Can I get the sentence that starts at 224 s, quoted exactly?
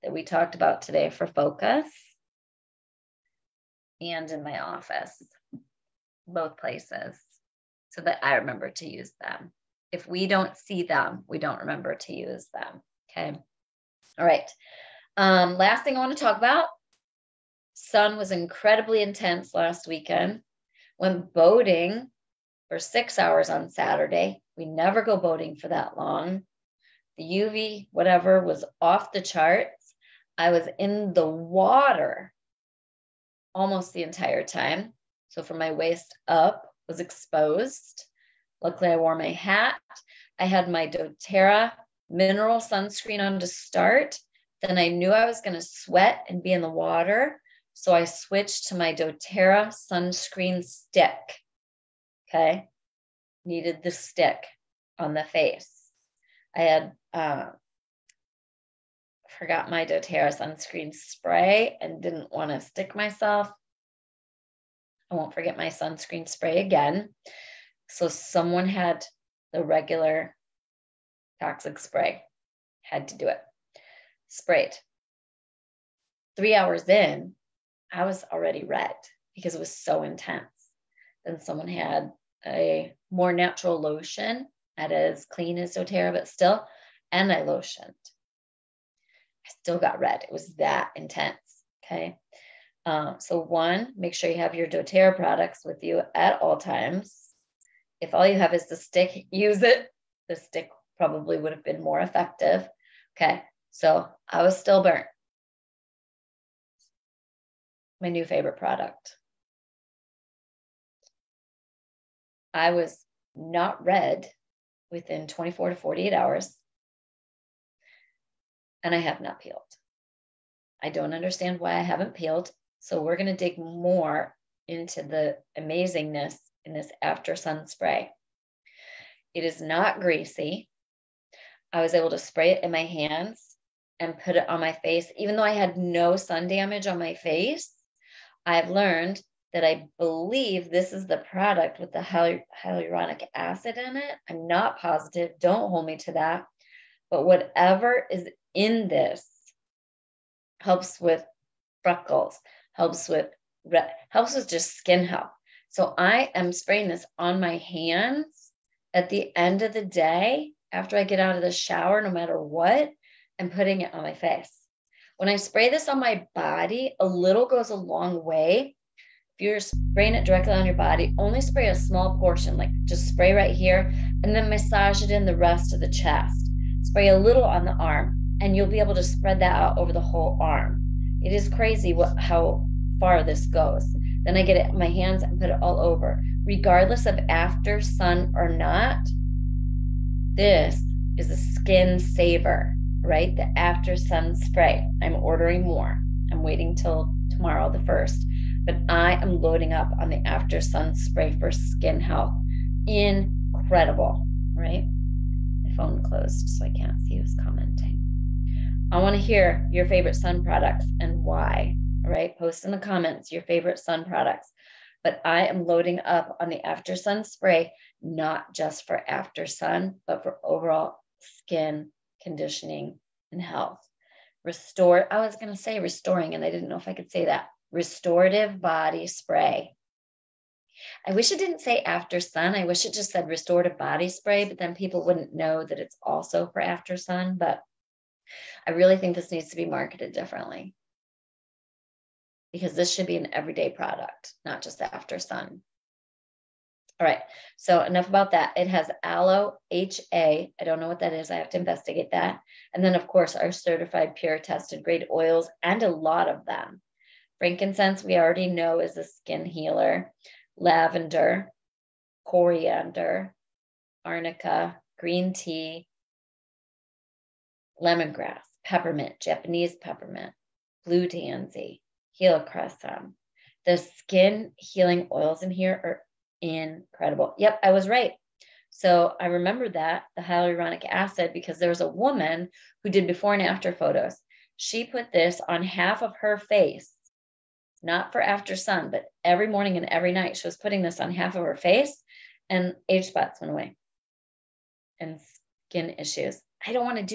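Restore, I was going to say restoring, and I didn't know if I could say that.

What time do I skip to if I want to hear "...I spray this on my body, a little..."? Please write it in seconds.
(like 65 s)
165 s.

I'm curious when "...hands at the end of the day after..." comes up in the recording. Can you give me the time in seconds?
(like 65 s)
157 s.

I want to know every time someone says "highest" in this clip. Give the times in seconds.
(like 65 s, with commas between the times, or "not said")
not said.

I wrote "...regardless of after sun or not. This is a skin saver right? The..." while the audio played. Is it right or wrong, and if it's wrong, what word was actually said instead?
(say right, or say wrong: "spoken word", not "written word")
right.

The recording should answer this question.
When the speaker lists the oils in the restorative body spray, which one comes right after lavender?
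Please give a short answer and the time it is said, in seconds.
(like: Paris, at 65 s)
coriander, at 262 s.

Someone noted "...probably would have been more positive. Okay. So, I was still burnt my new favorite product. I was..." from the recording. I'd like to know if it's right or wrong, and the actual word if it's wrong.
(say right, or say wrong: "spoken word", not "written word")
wrong: "effective", not "positive".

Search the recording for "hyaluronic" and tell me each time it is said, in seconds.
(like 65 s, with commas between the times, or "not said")
141 s, 280 s.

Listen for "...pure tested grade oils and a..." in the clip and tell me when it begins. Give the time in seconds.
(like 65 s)
254 s.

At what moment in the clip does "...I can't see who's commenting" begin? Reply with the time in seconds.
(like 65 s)
206 s.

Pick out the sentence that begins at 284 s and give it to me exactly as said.
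She put this on half of her face, not for after sun, but every morning and every night.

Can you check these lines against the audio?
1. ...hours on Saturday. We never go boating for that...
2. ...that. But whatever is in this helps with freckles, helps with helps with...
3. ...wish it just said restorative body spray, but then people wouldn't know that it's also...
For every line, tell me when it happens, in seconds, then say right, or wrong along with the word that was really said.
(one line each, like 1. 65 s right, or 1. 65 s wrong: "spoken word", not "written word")
1. 23 s right
2. 146 s right
3. 232 s right.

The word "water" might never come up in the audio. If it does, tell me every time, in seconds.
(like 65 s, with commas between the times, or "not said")
31 s, 46 s.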